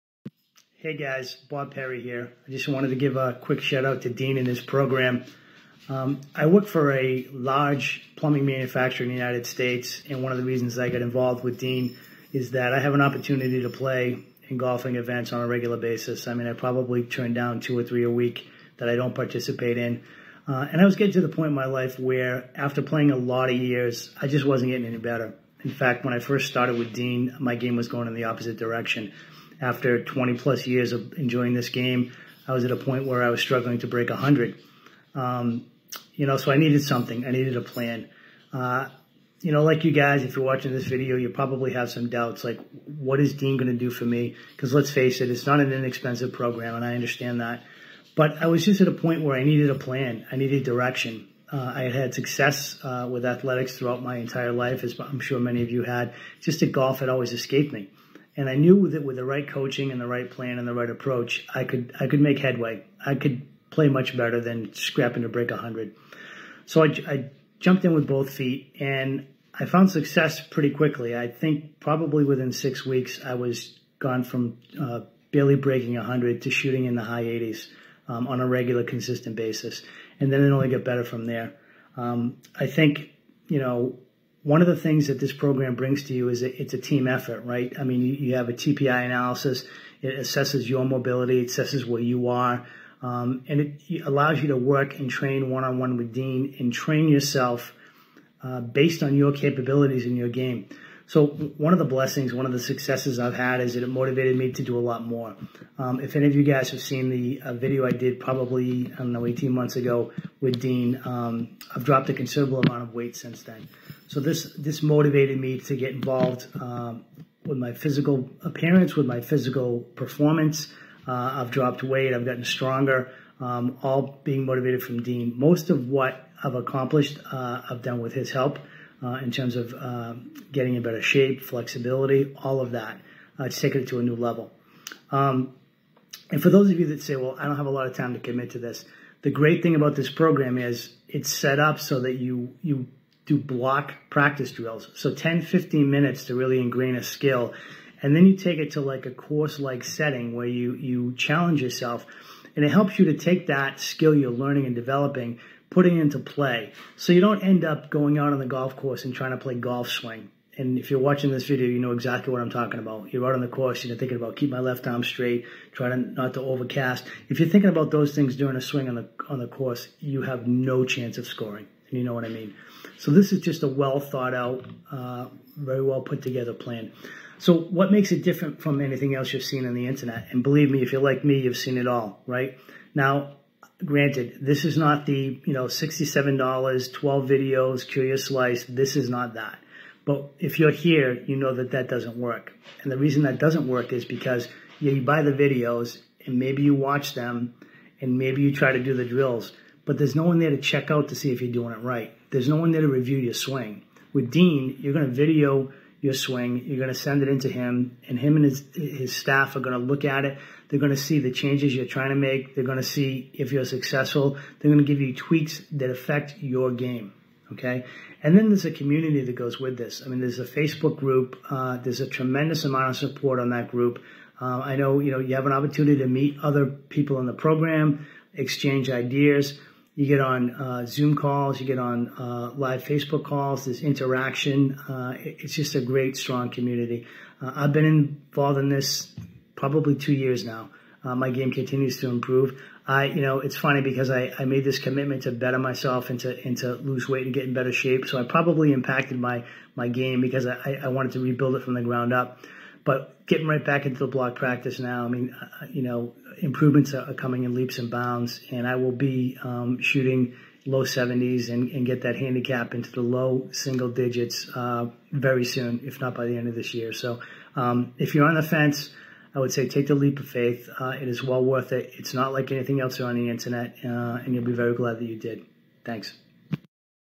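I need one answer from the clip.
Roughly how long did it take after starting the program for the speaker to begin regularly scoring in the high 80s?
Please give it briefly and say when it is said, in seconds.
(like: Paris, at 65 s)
6 weeks, at 72 s.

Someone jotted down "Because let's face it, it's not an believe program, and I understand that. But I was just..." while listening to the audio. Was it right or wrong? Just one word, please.
wrong.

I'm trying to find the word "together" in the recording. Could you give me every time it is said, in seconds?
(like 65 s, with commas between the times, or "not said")
176 s.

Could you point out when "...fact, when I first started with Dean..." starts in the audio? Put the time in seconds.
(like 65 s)
25 s.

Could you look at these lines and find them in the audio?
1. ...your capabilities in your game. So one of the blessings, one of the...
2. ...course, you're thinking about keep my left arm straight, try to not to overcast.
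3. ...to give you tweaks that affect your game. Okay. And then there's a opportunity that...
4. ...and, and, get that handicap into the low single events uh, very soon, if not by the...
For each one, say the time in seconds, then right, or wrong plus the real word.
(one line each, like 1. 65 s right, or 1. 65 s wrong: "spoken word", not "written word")
1. 99 s right
2. 163 s right
3. 214 s wrong: "community", not "opportunity"
4. 261 s wrong: "digits", not "events".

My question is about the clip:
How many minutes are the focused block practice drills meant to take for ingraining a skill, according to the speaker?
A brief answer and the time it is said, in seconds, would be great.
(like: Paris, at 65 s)
10 to 15 minutes, at 145 s.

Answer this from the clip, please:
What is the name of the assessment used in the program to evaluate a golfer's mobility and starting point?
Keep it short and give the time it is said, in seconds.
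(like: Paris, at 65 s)
TPI analysis, at 88 s.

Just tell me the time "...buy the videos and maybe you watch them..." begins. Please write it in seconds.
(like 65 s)
195 s.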